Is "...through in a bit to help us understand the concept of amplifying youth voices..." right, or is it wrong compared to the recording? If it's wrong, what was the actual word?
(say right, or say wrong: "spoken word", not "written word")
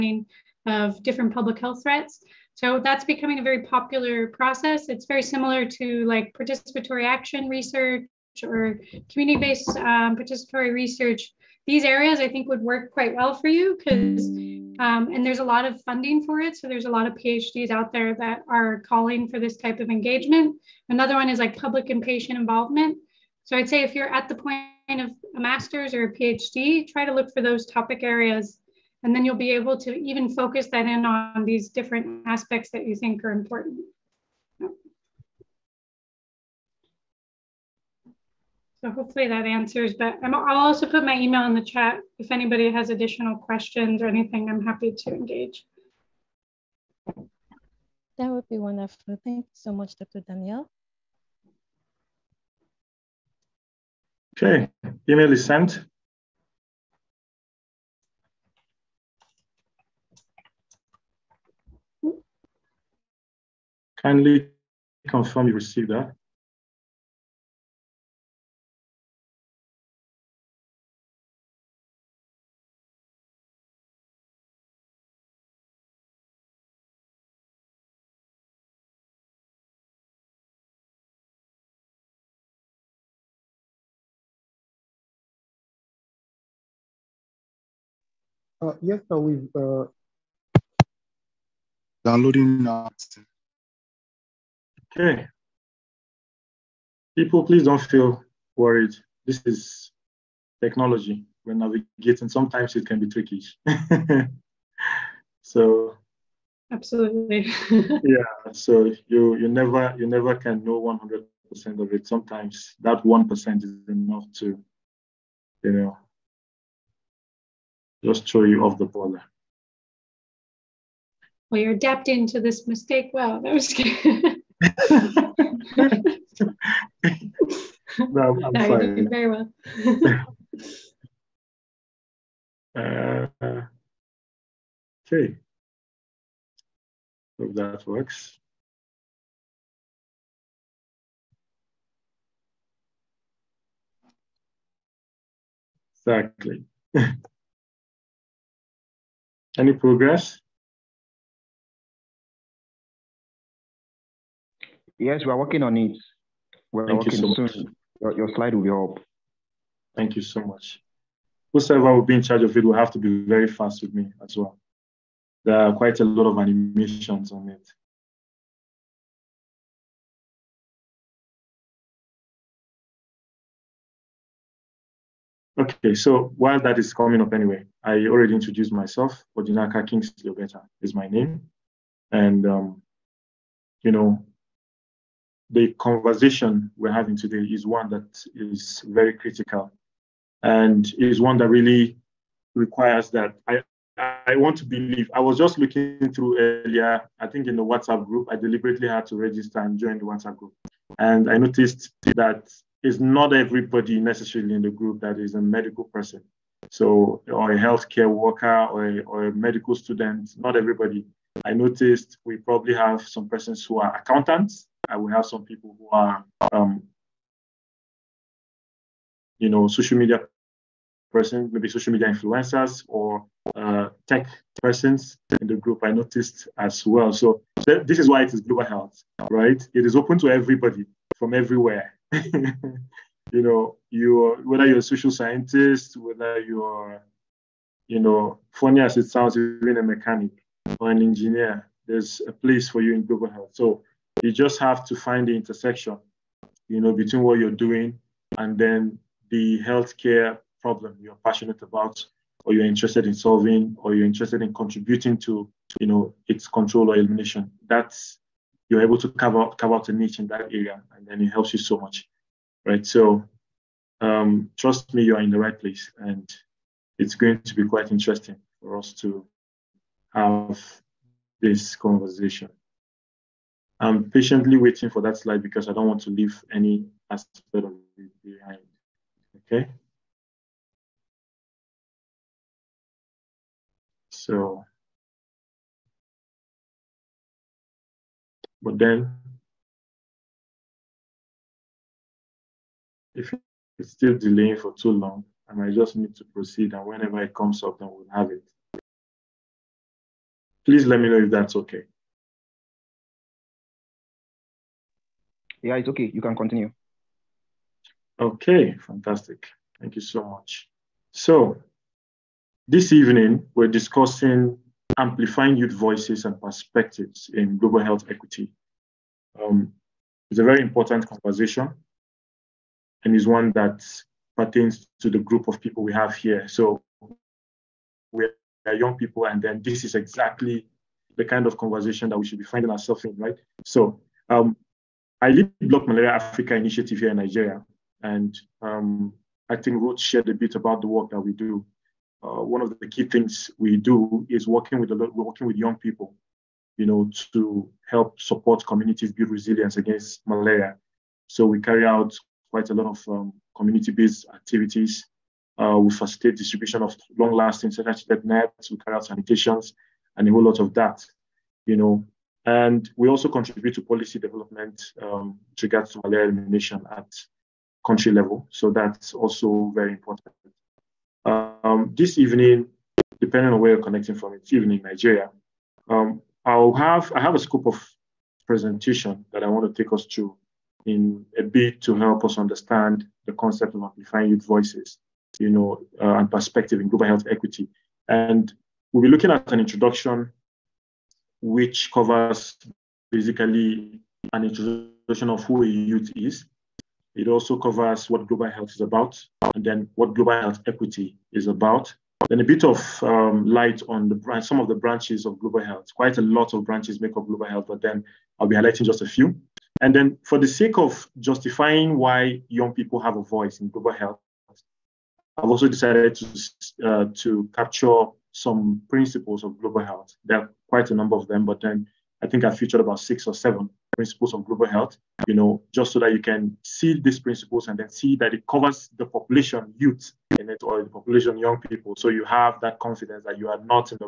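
right.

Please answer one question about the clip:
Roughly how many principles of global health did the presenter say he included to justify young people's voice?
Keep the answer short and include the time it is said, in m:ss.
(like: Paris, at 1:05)
About 6 or 7, at 7:02.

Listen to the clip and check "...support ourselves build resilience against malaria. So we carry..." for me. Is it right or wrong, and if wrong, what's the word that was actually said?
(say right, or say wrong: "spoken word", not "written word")
wrong: "communities", not "ourselves".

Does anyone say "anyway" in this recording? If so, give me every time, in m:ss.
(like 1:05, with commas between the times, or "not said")
2:57.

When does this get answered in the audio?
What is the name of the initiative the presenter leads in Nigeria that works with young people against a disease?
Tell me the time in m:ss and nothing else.
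5:35.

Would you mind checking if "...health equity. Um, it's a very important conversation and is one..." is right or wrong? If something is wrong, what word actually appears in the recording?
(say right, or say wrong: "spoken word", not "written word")
right.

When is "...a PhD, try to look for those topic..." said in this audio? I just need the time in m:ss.
0:26.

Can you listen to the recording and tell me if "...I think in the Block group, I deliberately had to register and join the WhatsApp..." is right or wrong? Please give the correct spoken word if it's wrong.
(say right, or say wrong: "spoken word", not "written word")
wrong: "WhatsApp", not "Block".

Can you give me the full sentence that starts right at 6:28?
And we'll be looking at an introduction which covers basically an introduction of who a youth is.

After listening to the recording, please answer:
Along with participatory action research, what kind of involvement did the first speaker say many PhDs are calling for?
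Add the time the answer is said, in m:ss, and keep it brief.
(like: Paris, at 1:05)
Public and patient involvement, at 0:21.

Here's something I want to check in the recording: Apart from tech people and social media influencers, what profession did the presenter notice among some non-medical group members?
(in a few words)
Accountants.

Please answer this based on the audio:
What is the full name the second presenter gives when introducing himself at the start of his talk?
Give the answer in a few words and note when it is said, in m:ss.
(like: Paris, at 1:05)
Odinaka Kingsley Obeta, at 2:59.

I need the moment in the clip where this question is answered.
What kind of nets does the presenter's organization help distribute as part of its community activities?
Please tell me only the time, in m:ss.
5:57.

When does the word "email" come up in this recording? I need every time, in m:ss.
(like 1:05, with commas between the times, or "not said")
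0:41, 0:55.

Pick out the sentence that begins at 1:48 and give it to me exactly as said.
So you you never you never can know 100% of it.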